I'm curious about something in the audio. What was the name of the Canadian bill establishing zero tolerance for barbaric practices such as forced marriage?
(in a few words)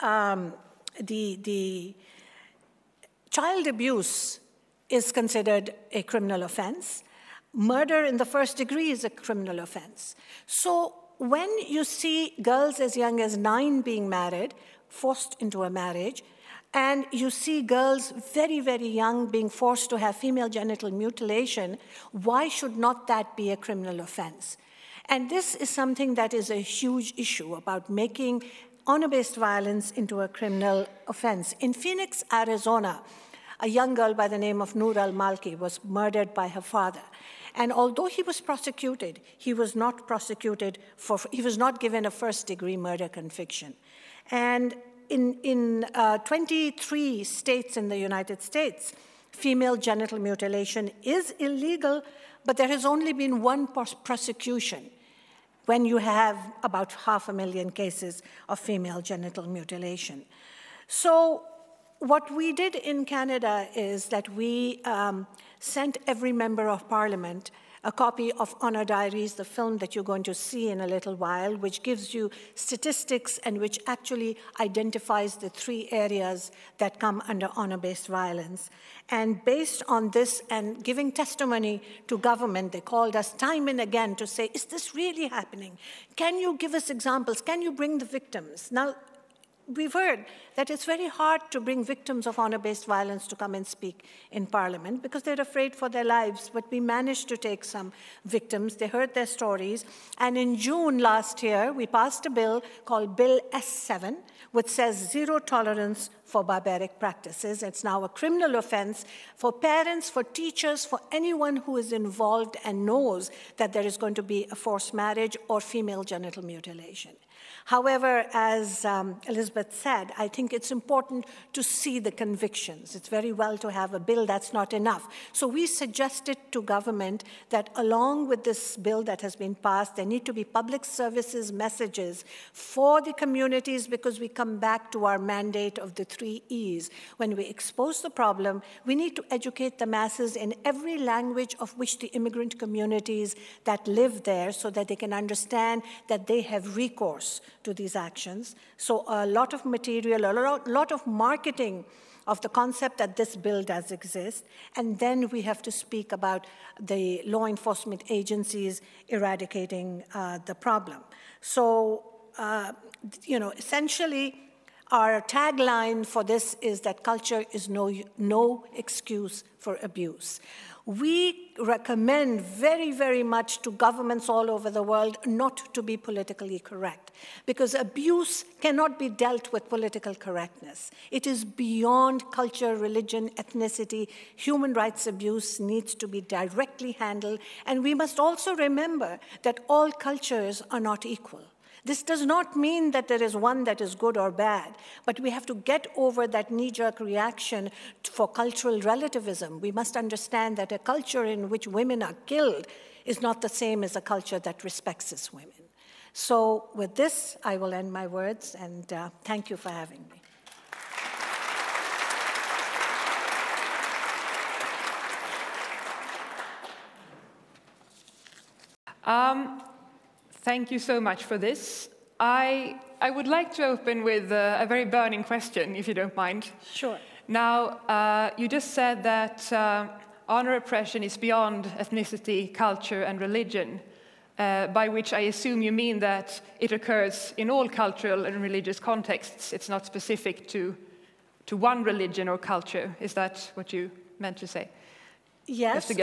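Bill S7.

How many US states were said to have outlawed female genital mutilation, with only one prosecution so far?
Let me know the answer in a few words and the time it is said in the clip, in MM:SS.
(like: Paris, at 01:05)
23, at 00:46.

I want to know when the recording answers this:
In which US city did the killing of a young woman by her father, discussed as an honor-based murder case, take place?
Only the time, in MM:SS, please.
00:31.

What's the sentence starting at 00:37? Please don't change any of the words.
And although he was prosecuted, he was not prosecuted for, he was not given a first degree murder conviction.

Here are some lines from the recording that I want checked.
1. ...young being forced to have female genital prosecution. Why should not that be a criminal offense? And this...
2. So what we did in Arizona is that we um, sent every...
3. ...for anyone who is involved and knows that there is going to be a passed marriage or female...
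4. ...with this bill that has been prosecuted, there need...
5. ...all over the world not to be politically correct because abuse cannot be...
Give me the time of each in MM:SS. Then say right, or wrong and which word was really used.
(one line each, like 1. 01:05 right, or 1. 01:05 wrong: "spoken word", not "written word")
1. 00:18 wrong: "mutilation", not "prosecution"
2. 01:00 wrong: "Canada", not "Arizona"
3. 01:50 wrong: "forced", not "passed"
4. 02:08 wrong: "passed", not "prosecuted"
5. 02:54 right.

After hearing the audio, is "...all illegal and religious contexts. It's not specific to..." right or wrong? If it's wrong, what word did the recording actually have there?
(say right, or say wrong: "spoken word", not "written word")
wrong: "cultural", not "illegal".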